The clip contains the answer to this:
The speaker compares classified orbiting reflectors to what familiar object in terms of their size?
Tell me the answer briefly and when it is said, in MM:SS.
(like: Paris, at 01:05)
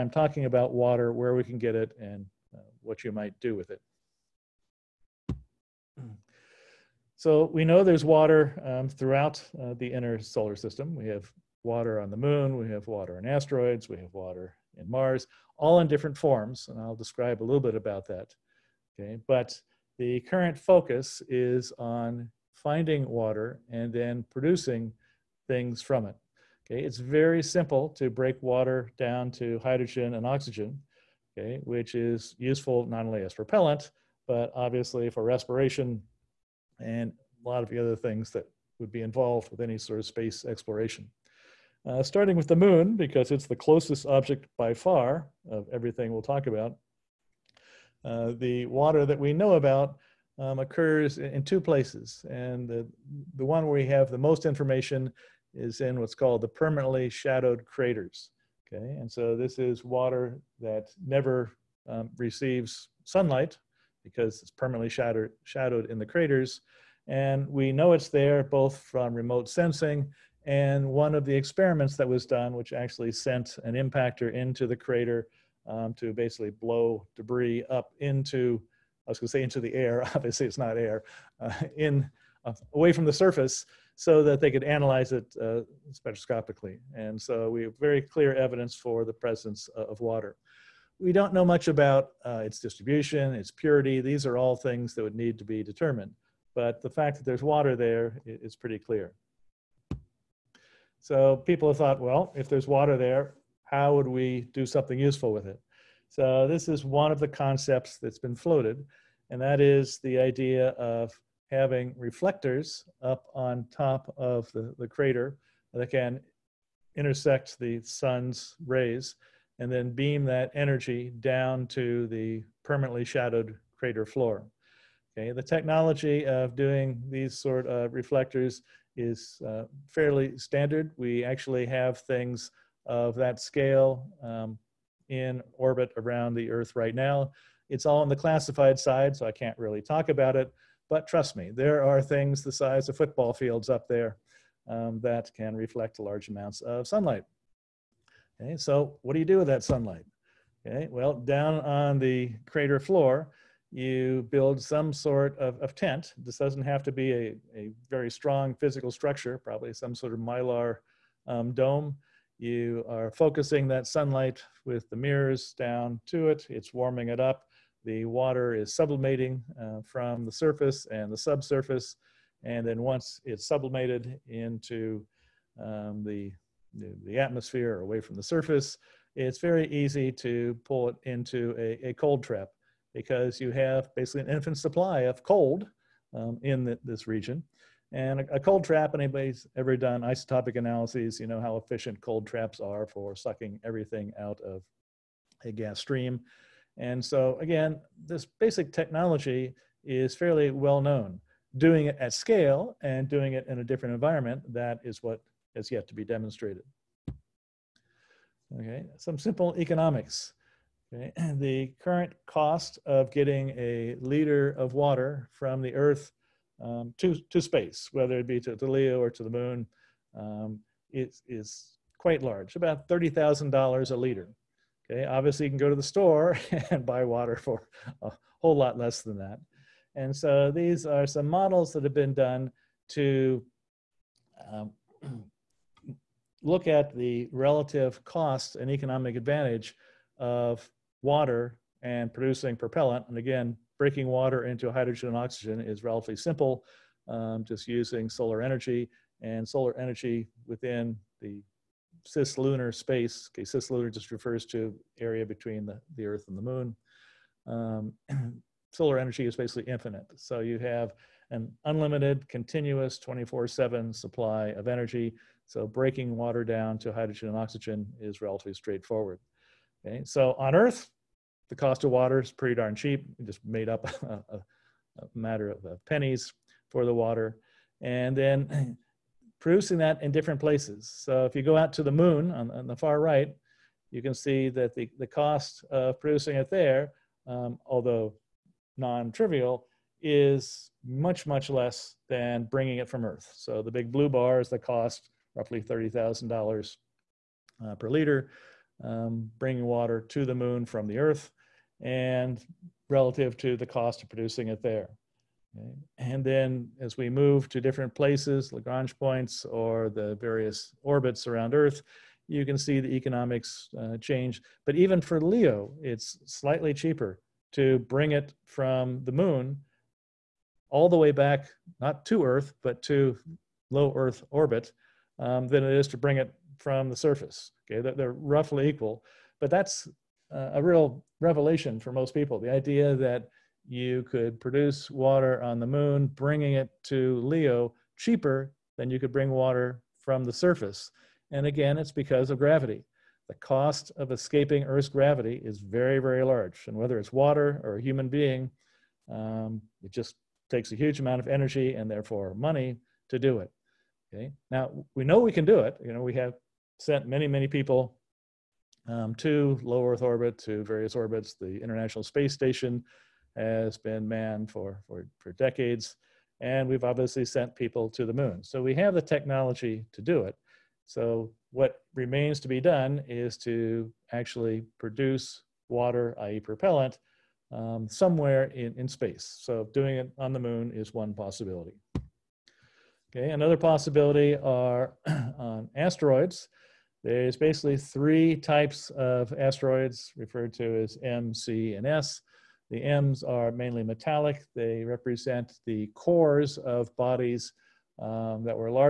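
football fields, at 02:22.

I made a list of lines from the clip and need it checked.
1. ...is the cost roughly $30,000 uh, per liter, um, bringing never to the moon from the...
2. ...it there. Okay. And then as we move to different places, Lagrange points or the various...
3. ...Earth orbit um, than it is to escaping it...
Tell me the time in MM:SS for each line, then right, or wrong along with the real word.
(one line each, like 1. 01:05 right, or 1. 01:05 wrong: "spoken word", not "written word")
1. 04:54 wrong: "water", not "never"
2. 05:04 right
3. 05:23 wrong: "bring", not "escaping".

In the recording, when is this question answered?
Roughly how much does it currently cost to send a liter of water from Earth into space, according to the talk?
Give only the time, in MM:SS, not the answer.
03:42.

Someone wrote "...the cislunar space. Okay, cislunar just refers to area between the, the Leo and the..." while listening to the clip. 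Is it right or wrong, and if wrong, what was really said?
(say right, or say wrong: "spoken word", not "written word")
wrong: "Earth", not "Leo".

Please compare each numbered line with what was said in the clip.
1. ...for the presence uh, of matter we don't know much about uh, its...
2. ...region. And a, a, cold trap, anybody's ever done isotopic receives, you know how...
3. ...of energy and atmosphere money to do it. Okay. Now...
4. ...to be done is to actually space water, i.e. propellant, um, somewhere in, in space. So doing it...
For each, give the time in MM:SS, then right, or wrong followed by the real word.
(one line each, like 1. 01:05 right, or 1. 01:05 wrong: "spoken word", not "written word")
1. 01:28 wrong: "water", not "matter"
2. 03:07 wrong: "analyses", not "receives"
3. 05:51 wrong: "therefore", not "atmosphere"
4. 06:12 wrong: "produce", not "space".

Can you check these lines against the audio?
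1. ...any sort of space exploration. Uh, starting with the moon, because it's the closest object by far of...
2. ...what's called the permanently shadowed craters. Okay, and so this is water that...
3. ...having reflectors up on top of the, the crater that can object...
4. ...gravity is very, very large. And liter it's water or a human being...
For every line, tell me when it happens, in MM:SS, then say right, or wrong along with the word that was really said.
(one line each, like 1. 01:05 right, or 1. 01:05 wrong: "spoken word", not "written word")
1. 00:39 right
2. 00:55 right
3. 01:51 wrong: "intersect", not "object"
4. 05:44 wrong: "whether", not "liter".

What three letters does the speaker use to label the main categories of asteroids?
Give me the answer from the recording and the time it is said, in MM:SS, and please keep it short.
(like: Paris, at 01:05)
M, C, and S, at 06:31.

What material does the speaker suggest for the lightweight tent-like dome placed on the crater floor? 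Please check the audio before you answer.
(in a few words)
mylar.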